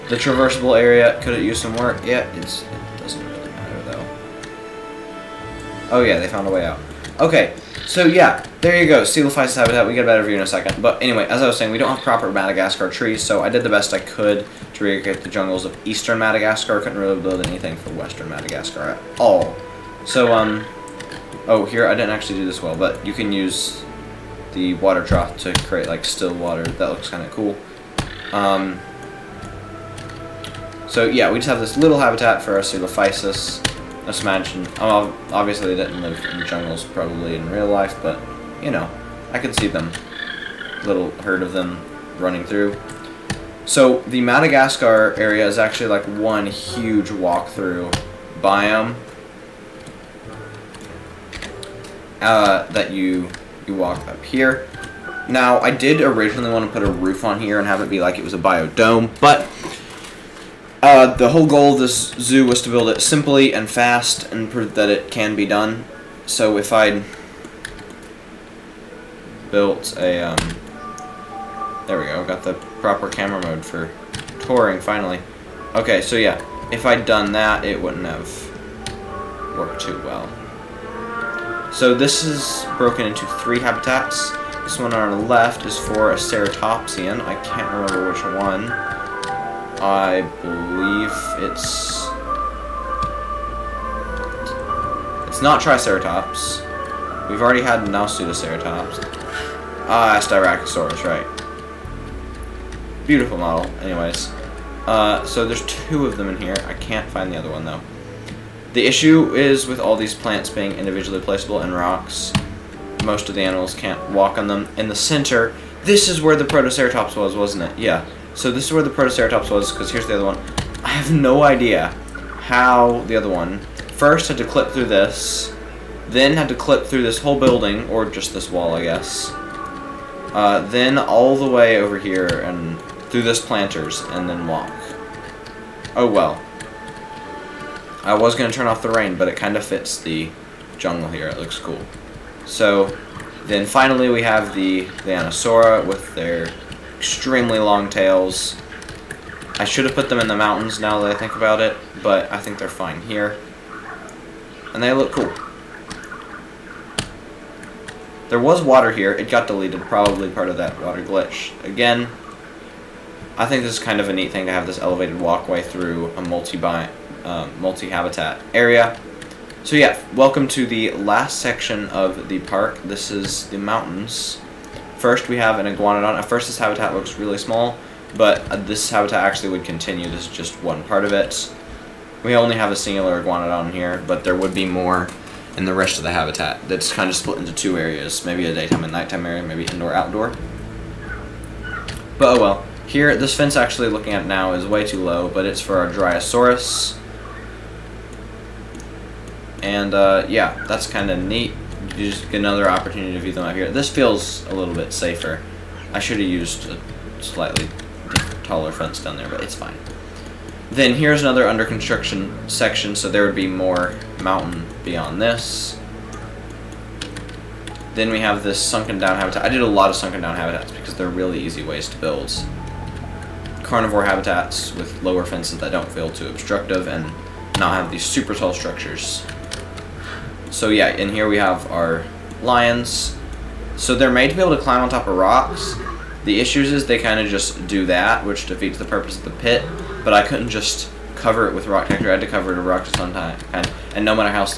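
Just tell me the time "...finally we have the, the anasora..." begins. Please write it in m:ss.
2:23.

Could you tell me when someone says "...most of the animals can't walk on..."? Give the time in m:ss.
1:53.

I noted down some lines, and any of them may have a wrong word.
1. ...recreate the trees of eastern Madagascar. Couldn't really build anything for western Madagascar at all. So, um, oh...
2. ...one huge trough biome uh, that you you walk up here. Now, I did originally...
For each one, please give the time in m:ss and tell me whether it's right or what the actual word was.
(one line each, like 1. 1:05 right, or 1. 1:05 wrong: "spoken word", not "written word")
1. 0:14 wrong: "jungles", not "trees"
2. 0:46 wrong: "walkthrough", not "trough".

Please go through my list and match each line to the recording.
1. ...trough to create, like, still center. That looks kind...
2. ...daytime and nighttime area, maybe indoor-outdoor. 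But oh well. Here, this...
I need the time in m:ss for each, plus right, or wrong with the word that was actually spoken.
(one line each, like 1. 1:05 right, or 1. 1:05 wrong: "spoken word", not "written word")
1. 0:25 wrong: "water", not "center"
2. 3:08 right.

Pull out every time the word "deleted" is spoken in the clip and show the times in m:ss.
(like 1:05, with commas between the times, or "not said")
2:39.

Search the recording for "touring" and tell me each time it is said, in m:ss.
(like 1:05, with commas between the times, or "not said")
1:14.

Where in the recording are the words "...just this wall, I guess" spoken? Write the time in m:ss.
2:08.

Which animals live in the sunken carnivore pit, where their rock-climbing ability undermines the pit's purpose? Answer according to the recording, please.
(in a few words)
Lions.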